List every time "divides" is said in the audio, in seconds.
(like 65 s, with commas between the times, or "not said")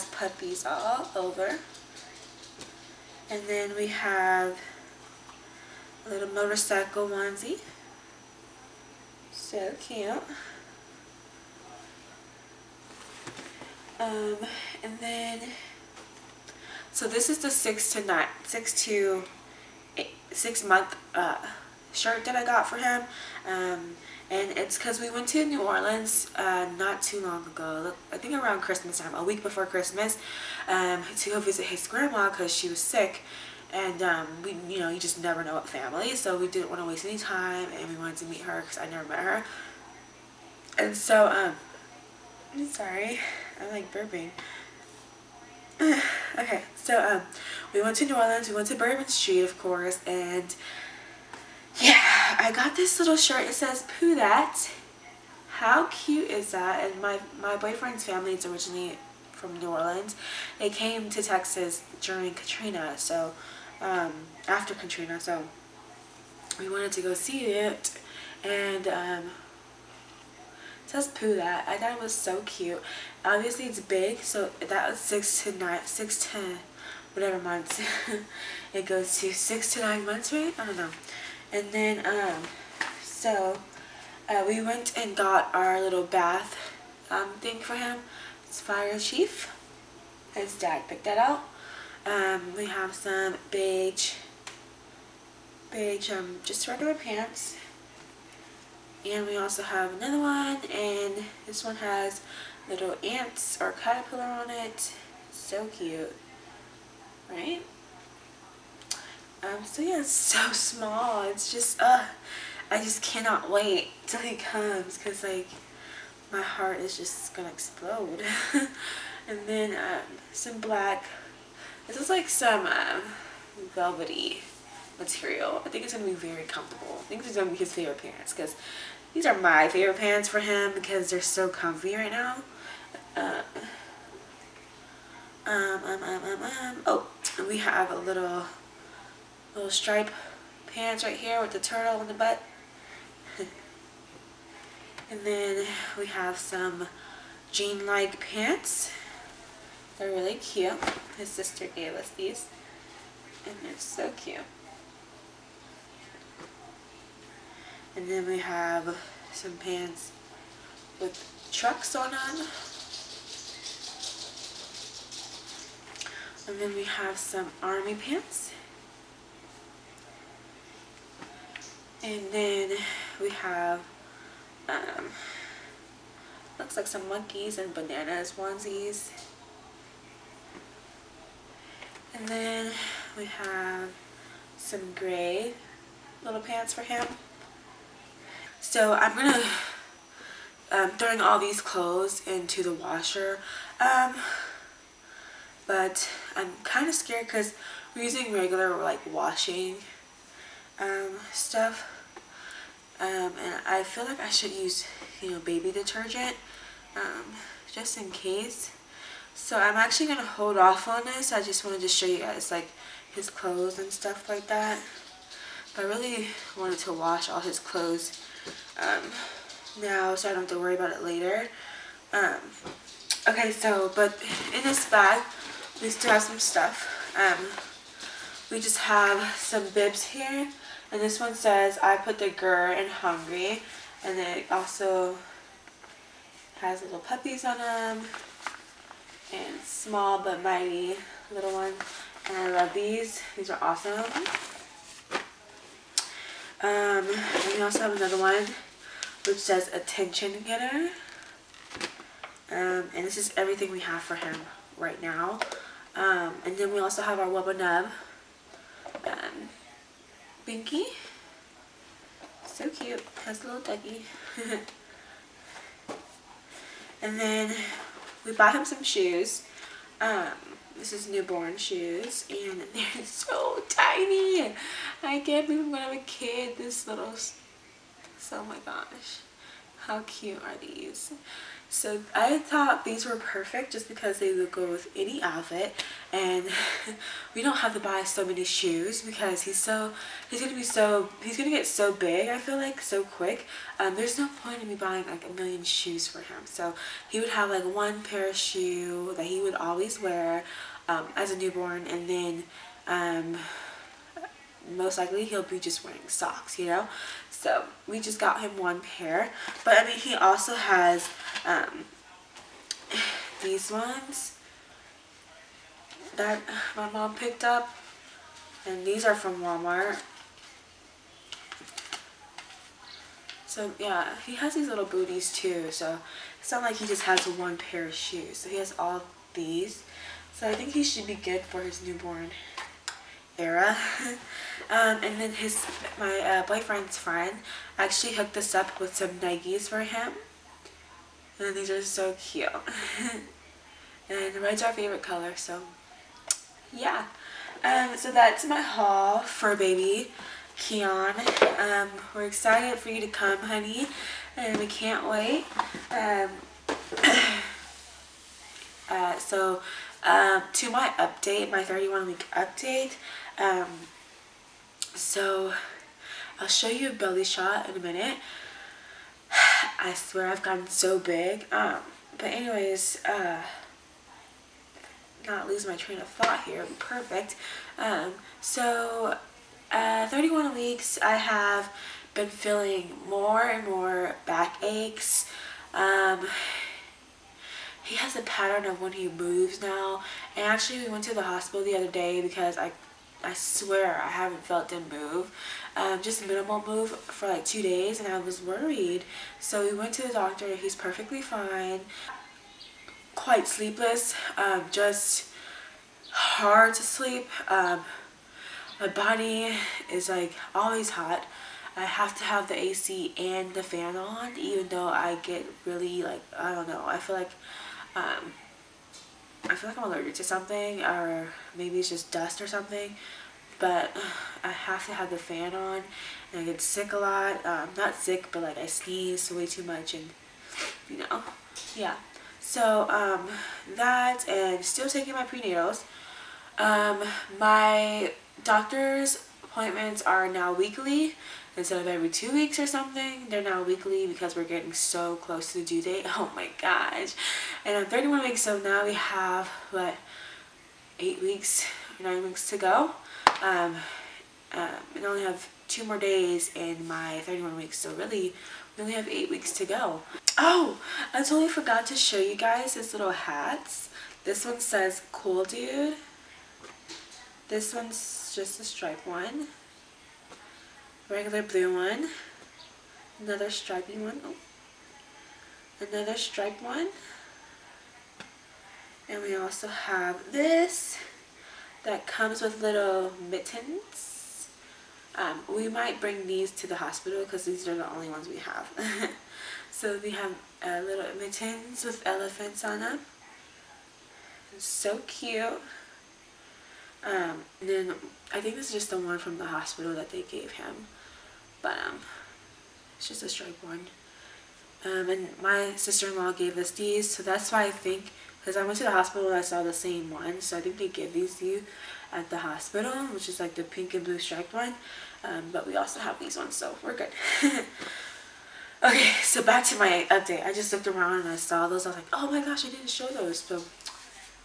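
not said.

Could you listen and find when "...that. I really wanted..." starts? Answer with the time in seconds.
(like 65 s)
214 s.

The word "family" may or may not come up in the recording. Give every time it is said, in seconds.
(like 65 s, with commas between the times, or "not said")
35 s, 58 s.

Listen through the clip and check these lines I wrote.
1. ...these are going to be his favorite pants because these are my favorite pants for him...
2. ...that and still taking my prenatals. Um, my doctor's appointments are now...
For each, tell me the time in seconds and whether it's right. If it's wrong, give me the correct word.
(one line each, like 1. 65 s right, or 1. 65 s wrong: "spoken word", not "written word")
1. 127 s right
2. 433 s right.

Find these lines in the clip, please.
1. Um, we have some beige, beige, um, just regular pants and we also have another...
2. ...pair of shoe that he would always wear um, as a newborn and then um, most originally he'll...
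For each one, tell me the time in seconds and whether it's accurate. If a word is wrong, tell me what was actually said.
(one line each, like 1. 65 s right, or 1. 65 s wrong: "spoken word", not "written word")
1. 92 s right
2. 298 s wrong: "likely", not "originally".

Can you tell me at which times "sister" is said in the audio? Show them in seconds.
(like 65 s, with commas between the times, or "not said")
151 s, 505 s.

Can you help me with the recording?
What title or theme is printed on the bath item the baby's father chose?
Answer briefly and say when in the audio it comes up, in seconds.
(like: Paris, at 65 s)
Fire Chief, at 88 s.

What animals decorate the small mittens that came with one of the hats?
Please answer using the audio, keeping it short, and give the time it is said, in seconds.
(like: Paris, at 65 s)
elephants, at 492 s.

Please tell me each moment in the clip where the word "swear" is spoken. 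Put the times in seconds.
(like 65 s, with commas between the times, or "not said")
369 s, 393 s.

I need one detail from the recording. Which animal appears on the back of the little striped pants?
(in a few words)
turtle.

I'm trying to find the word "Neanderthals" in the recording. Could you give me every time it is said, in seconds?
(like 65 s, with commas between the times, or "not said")
not said.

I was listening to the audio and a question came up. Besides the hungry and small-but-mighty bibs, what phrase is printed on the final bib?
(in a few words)
attention getter.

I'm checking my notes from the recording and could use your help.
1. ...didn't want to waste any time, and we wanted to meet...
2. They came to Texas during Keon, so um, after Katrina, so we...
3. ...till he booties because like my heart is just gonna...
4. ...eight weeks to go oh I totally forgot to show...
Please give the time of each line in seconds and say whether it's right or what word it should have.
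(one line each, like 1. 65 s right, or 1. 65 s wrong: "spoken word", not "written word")
1. 36 s right
2. 60 s wrong: "Katrina", not "Keon"
3. 114 s wrong: "comes", not "booties"
4. 459 s right.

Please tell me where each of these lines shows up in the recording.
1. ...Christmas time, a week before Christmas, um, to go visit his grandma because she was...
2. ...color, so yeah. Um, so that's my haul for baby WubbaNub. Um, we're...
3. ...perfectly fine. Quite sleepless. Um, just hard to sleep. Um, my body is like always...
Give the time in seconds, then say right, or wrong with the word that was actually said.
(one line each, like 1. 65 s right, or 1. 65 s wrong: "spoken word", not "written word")
1. 28 s right
2. 345 s wrong: "Keon", not "WubbaNub"
3. 400 s right.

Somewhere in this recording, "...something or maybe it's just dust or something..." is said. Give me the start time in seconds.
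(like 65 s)
420 s.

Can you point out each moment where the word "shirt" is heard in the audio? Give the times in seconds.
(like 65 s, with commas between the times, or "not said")
21 s, 53 s.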